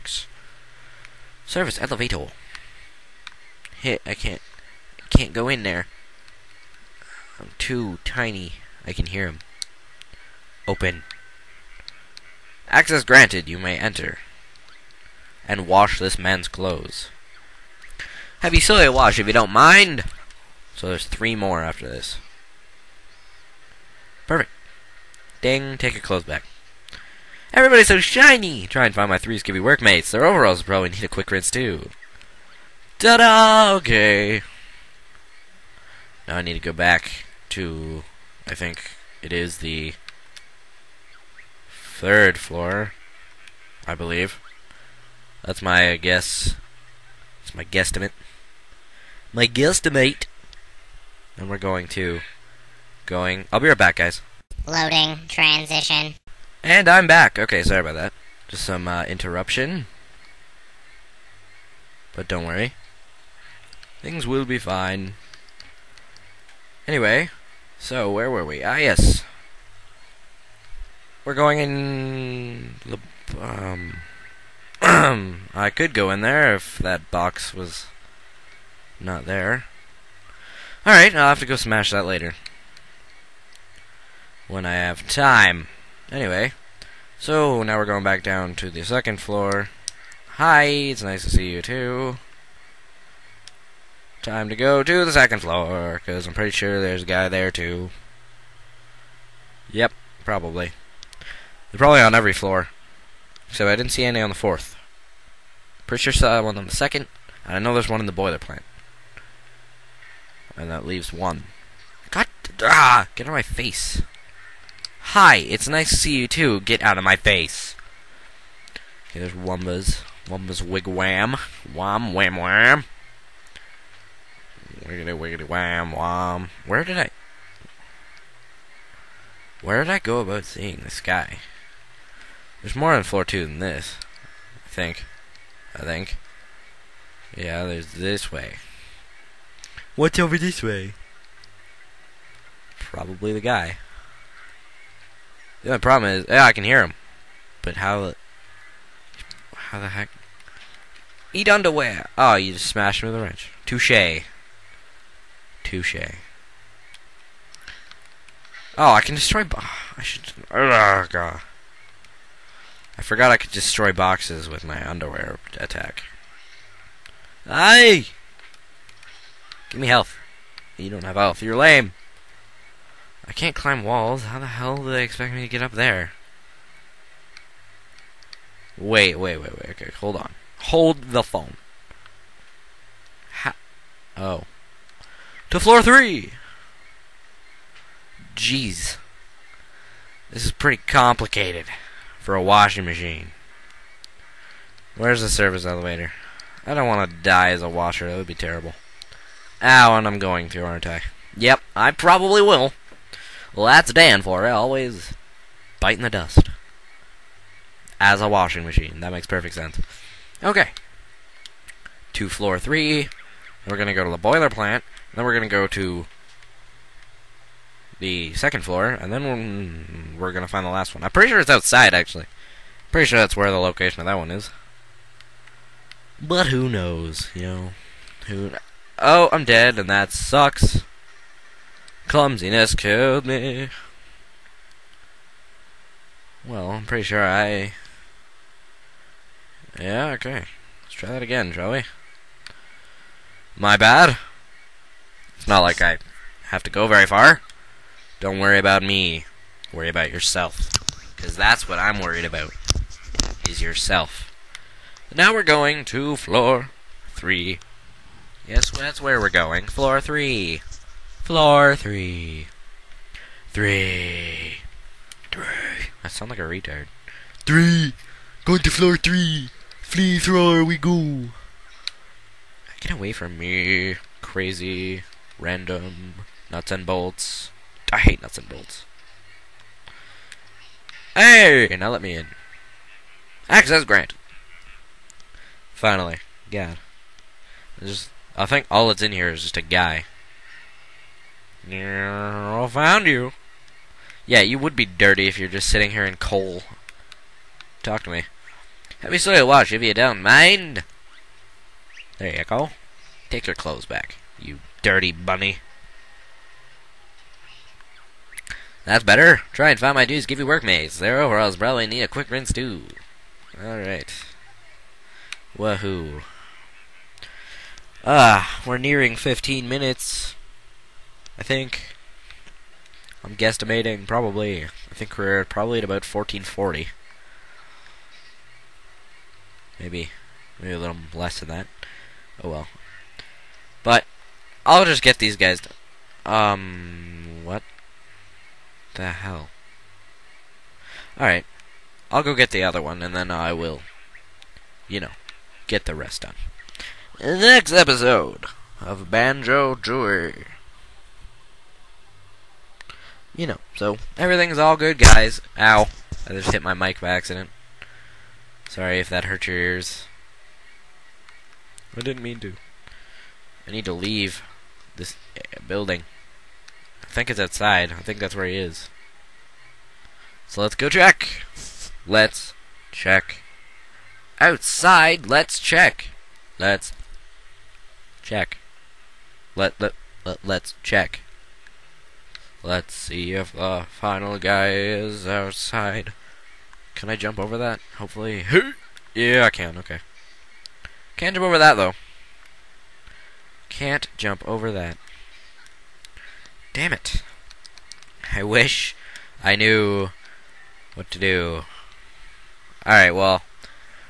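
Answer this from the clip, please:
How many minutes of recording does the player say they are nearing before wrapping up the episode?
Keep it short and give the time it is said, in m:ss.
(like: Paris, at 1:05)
15, at 5:19.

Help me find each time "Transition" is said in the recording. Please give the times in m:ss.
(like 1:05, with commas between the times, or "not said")
0:55.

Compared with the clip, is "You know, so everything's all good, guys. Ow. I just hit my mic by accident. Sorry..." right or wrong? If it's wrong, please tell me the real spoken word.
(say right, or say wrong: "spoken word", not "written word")
right.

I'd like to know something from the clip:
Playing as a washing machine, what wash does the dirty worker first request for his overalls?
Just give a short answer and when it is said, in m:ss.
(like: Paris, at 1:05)
Heavy soy wash, at 0:18.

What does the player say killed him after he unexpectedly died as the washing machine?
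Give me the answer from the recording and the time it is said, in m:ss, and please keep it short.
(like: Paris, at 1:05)
Clumsiness, at 3:52.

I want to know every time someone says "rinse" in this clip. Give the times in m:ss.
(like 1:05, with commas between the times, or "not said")
0:31, 5:12.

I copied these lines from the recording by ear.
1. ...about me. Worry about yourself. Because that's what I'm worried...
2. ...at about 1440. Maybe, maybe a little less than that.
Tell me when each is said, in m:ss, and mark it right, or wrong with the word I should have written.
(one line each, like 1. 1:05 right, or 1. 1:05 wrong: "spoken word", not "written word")
1. 4:08 right
2. 5:25 right.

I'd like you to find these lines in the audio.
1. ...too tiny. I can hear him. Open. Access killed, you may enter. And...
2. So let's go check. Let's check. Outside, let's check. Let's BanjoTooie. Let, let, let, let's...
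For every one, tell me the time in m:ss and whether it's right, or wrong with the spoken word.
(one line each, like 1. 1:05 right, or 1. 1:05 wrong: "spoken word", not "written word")
1. 0:07 wrong: "granted", not "killed"
2. 6:10 wrong: "Check", not "BanjoTooie".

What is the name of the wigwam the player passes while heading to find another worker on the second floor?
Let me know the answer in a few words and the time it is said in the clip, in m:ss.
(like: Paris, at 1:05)
Wumba's wigwam, at 2:00.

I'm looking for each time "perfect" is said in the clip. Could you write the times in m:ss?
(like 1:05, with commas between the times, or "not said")
0:24, 3:29.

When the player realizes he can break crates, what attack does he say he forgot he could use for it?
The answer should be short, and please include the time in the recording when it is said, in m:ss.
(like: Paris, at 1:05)
underwear attack, at 2:44.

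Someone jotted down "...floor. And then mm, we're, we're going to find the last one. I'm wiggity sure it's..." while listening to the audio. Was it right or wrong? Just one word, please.
wrong.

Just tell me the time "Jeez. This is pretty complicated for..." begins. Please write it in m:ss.
3:08.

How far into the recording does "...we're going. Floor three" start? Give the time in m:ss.
4:19.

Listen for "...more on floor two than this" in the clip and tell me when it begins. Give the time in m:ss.
2:12.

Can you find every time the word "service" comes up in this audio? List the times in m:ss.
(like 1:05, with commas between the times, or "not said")
0:01, 3:15.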